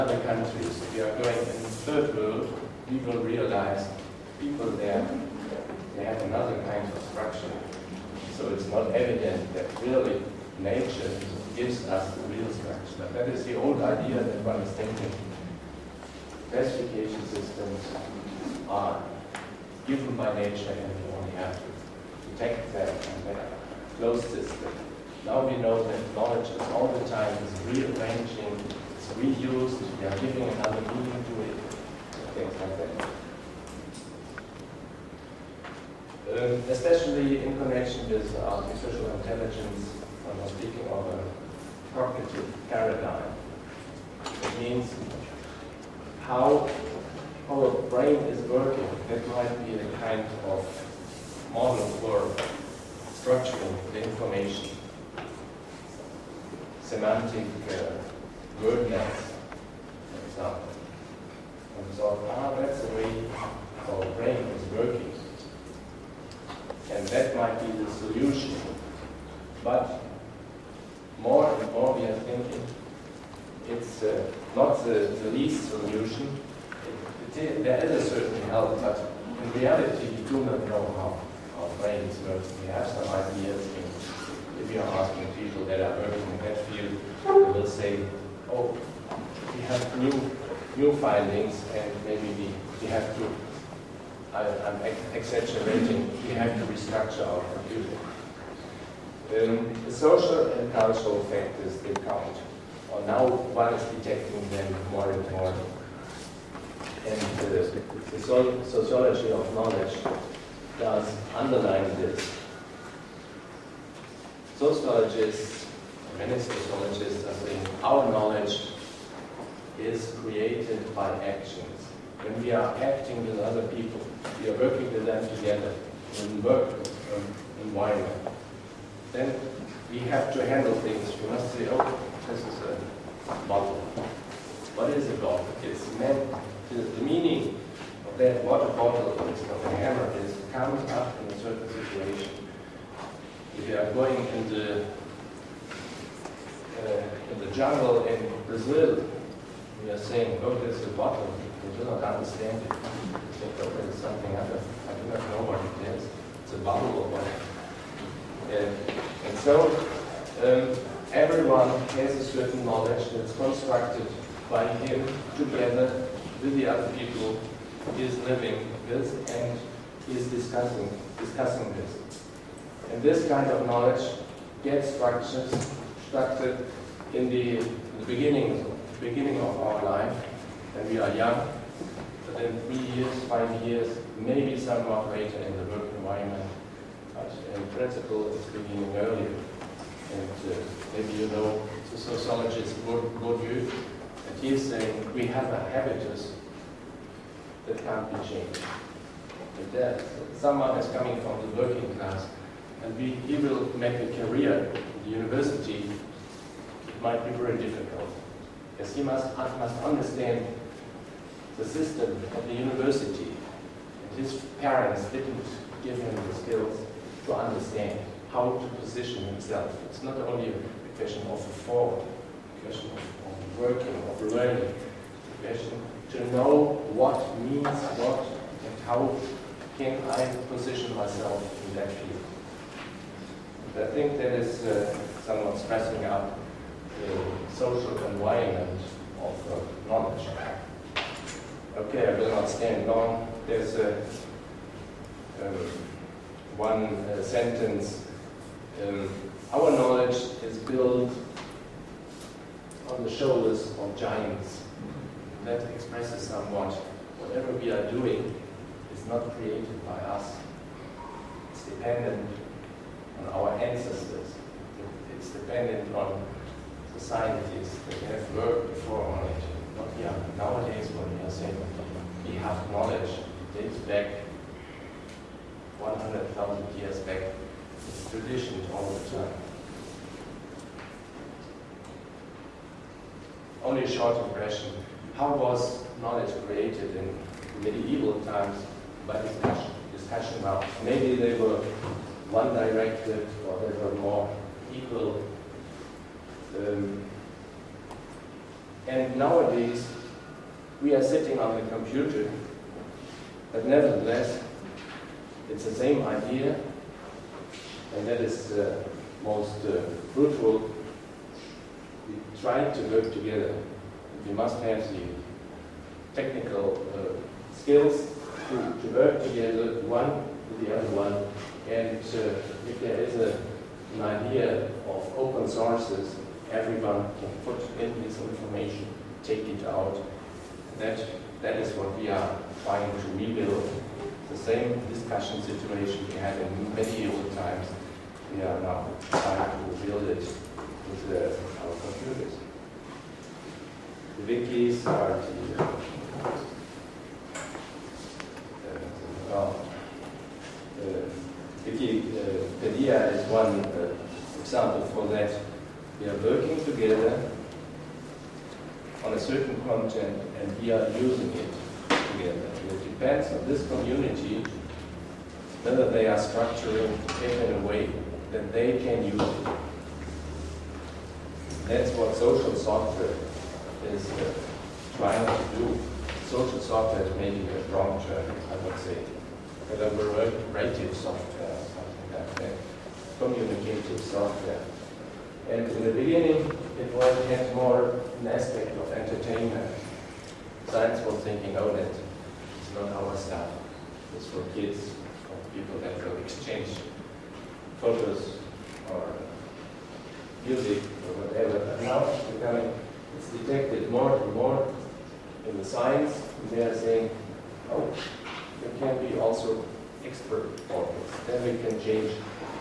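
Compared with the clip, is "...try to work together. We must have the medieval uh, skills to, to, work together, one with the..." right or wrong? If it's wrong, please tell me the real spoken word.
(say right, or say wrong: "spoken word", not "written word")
wrong: "technical", not "medieval".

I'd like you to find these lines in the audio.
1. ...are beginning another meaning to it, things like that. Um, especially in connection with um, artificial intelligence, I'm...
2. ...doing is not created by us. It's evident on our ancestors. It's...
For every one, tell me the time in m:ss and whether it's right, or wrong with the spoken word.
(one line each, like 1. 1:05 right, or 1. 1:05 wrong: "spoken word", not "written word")
1. 0:30 wrong: "giving", not "beginning"
2. 4:17 wrong: "dependent", not "evident".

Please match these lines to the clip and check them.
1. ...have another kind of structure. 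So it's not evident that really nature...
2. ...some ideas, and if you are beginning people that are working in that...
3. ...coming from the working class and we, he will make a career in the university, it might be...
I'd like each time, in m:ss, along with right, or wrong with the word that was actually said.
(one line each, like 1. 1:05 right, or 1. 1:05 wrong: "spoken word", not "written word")
1. 0:06 right
2. 1:22 wrong: "asking", not "beginning"
3. 3:20 right.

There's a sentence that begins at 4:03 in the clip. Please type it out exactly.
There's a, um, one uh, sentence.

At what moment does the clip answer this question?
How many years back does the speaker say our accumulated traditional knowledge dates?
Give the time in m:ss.
4:35.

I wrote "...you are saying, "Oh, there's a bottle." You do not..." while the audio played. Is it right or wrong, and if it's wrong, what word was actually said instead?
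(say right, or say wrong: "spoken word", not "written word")
right.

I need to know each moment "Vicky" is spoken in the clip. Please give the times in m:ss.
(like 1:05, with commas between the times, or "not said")
5:51.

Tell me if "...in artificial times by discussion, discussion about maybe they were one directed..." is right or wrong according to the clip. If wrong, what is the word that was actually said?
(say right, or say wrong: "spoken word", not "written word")
wrong: "medieval", not "artificial".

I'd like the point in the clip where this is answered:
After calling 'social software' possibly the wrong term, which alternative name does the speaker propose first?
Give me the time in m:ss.
6:19.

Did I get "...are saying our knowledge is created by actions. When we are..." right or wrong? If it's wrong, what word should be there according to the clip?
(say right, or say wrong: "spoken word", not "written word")
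right.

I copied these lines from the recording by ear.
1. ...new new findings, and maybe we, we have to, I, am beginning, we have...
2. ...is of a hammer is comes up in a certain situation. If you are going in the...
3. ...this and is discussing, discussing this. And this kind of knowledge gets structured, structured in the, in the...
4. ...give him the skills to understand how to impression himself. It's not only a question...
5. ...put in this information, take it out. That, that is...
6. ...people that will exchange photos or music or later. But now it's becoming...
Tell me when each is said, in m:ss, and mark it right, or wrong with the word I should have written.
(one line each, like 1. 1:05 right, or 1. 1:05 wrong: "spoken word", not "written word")
1. 1:30 wrong: "exaggerating", not "beginning"
2. 2:19 right
3. 2:48 right
4. 3:35 wrong: "position", not "impression"
5. 5:27 right
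6. 6:35 wrong: "whatever", not "later".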